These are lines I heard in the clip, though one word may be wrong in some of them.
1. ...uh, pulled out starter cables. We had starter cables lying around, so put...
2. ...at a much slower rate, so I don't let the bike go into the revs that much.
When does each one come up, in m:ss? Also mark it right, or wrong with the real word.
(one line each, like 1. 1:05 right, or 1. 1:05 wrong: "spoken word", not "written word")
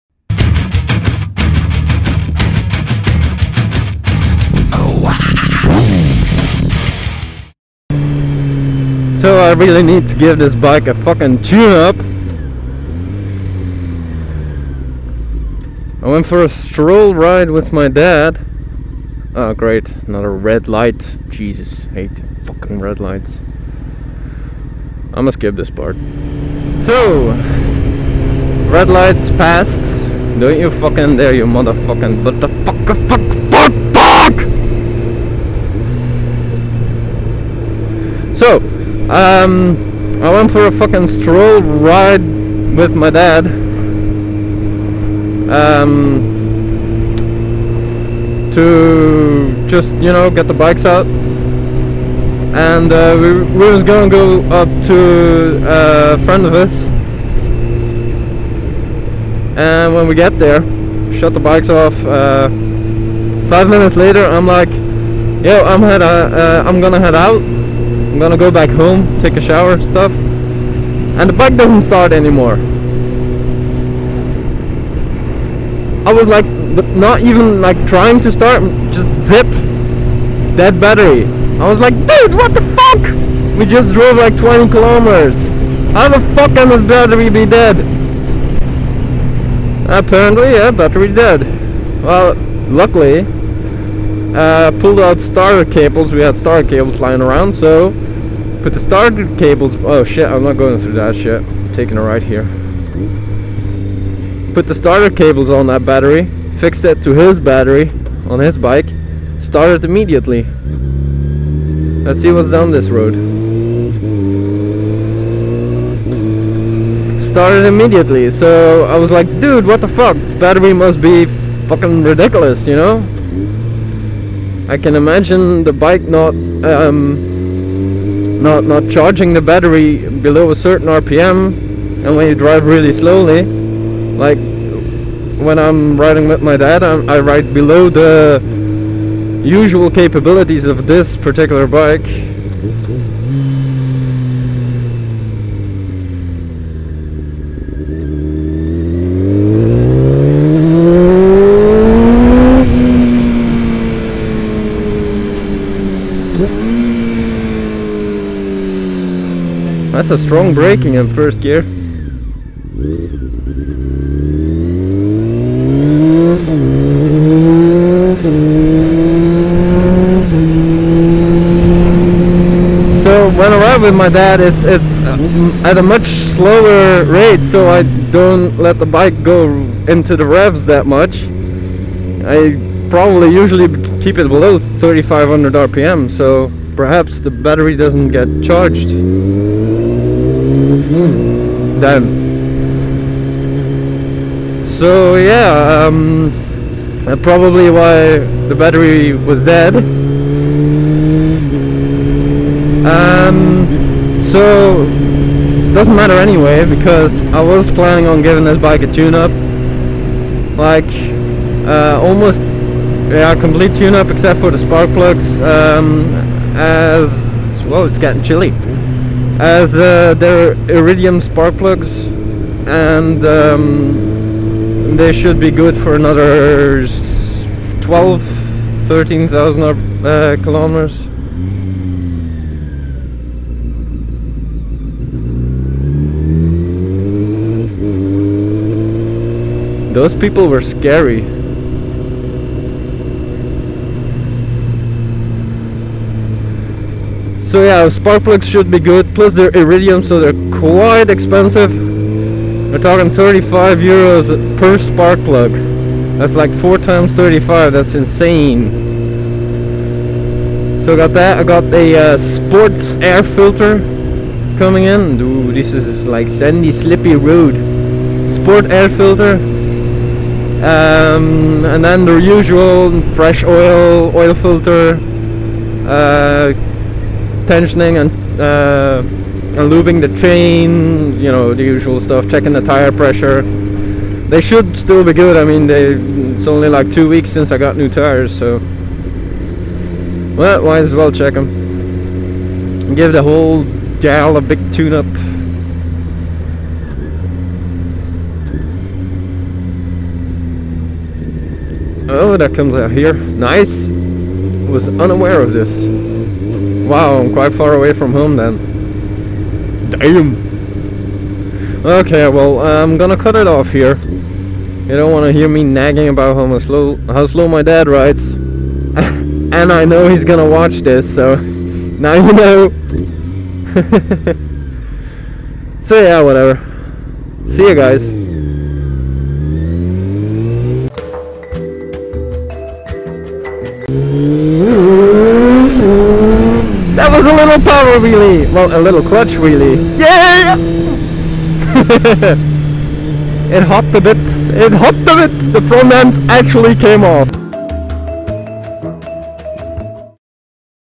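1. 1:34 right
2. 2:55 right.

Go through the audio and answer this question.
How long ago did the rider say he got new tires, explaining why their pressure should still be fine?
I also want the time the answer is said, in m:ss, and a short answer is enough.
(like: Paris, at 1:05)
2 weeks, at 4:46.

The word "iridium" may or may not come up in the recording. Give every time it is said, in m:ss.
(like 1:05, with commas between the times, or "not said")
3:40, 4:09.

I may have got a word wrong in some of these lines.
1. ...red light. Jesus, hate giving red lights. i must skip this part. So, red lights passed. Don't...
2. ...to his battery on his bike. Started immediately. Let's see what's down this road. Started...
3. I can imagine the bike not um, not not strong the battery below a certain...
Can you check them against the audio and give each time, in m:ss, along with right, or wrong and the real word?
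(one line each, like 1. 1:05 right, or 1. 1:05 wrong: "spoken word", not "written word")
1. 0:20 wrong: "fucking", not "giving"
2. 1:47 right
3. 2:04 wrong: "charging", not "strong".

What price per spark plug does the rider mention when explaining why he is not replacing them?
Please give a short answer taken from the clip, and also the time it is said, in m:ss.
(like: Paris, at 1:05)
35 euros, at 4:13.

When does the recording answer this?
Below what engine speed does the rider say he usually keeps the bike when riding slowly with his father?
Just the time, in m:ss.
3:04.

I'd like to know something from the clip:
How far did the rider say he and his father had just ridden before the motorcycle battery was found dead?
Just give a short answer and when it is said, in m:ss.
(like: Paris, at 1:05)
20 kilometers, at 1:24.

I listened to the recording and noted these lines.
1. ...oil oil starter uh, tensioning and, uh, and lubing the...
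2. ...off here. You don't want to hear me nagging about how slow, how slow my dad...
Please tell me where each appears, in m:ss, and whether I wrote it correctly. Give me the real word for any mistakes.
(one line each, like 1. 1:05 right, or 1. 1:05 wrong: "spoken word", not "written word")
1. 4:33 wrong: "filter", not "starter"
2. 5:13 right.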